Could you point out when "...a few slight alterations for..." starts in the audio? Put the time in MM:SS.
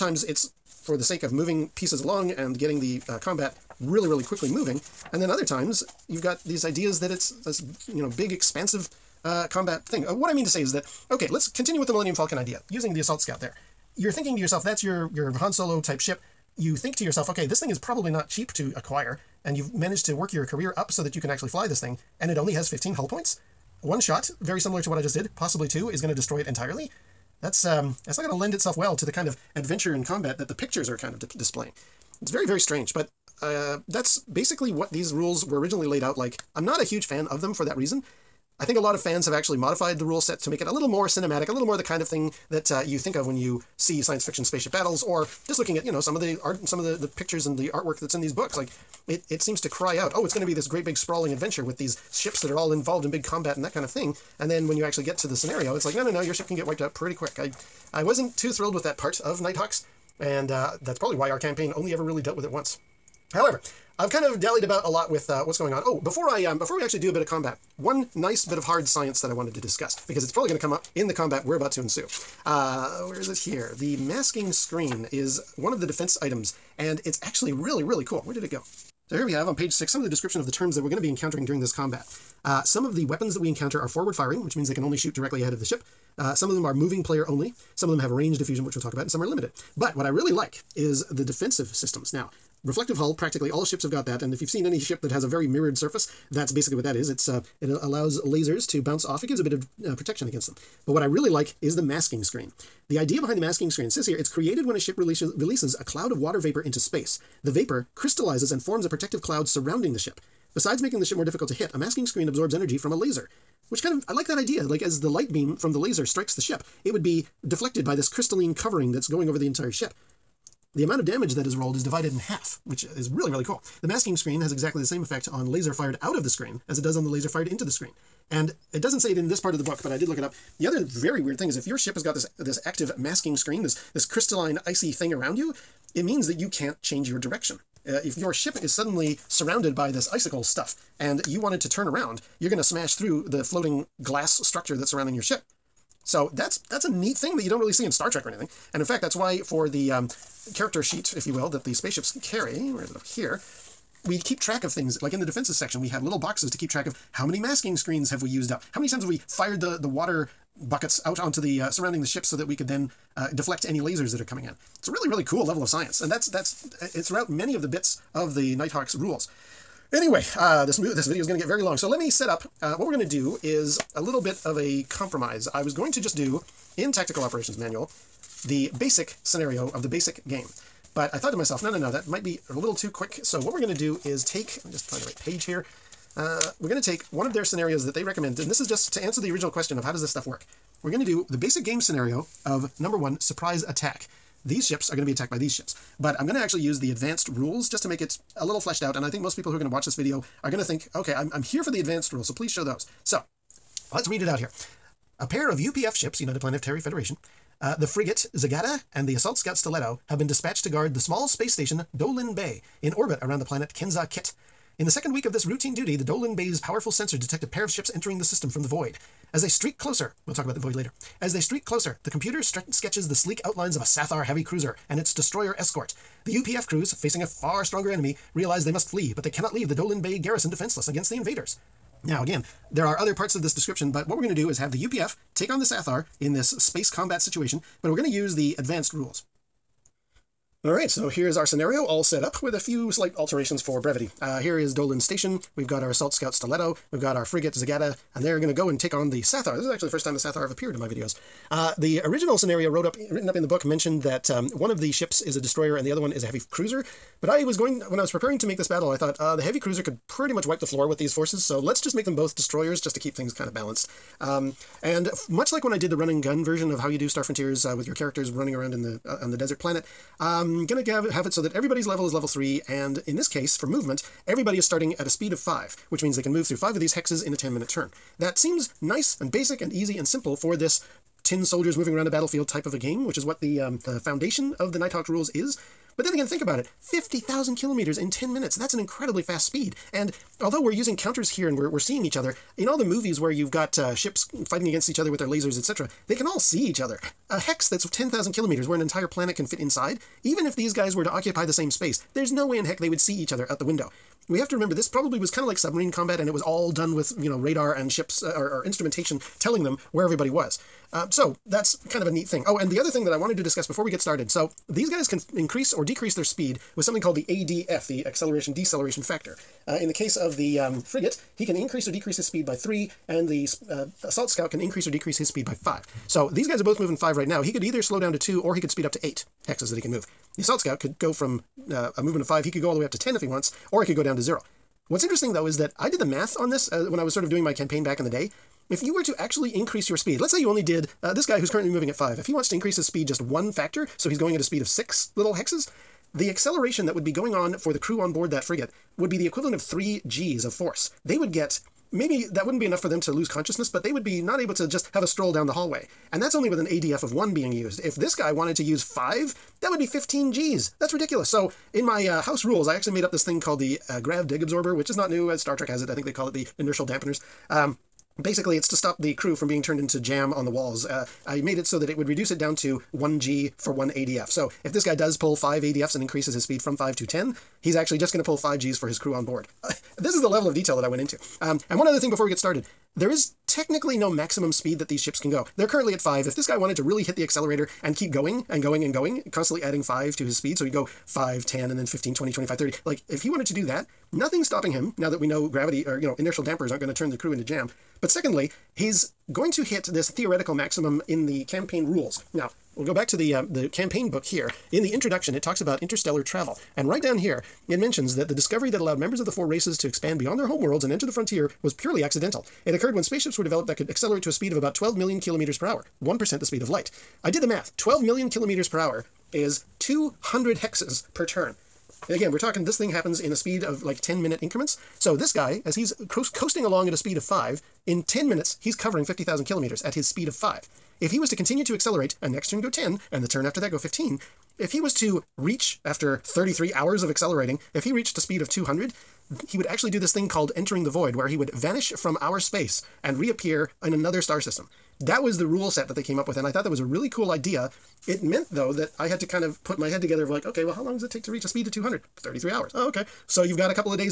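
04:02.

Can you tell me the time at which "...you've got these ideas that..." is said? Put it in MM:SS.
00:06.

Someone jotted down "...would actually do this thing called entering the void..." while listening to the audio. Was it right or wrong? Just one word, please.
right.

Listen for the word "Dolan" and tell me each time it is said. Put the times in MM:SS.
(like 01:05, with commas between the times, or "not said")
03:31, 03:36, 03:49, 04:04.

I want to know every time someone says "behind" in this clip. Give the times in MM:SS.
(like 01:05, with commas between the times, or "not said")
01:43.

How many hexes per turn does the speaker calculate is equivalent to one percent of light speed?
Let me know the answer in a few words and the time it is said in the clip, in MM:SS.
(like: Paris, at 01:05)
200, at 06:59.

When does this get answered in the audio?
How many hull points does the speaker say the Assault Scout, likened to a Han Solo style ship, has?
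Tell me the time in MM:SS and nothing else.
00:22.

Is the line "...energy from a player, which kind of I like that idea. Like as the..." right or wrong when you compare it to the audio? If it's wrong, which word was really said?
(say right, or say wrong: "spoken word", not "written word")
wrong: "laser", not "player".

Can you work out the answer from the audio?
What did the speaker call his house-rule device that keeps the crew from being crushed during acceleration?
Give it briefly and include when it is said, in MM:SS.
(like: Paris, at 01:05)
grav dig absorber, at 06:03.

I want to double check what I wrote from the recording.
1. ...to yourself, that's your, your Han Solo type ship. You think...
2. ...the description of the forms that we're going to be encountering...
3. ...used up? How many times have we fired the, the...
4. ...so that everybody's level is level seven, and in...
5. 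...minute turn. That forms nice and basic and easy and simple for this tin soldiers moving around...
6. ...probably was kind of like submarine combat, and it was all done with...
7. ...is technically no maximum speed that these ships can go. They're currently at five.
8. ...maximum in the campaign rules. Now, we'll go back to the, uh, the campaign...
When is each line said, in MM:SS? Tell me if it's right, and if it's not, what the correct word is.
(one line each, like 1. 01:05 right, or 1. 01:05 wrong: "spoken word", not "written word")
1. 00:14 right
2. 01:20 wrong: "terms", not "forms"
3. 02:38 right
4. 04:31 wrong: "three", not "seven"
5. 04:37 wrong: "seems", not "forms"
6. 05:04 right
7. 06:23 right
8. 06:40 right.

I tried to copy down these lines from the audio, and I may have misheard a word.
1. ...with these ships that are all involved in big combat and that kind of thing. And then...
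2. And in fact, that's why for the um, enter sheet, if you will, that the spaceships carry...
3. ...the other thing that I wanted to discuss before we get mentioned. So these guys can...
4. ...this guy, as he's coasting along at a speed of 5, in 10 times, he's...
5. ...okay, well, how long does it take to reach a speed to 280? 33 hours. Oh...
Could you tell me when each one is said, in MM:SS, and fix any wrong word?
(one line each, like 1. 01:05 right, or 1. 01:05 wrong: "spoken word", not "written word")
1. 00:51 right
2. 02:28 wrong: "character", not "enter"
3. 05:12 wrong: "started", not "mentioned"
4. 07:05 wrong: "minutes", not "times"
5. 07:30 wrong: "200", not "280".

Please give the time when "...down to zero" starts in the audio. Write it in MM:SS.
05:34.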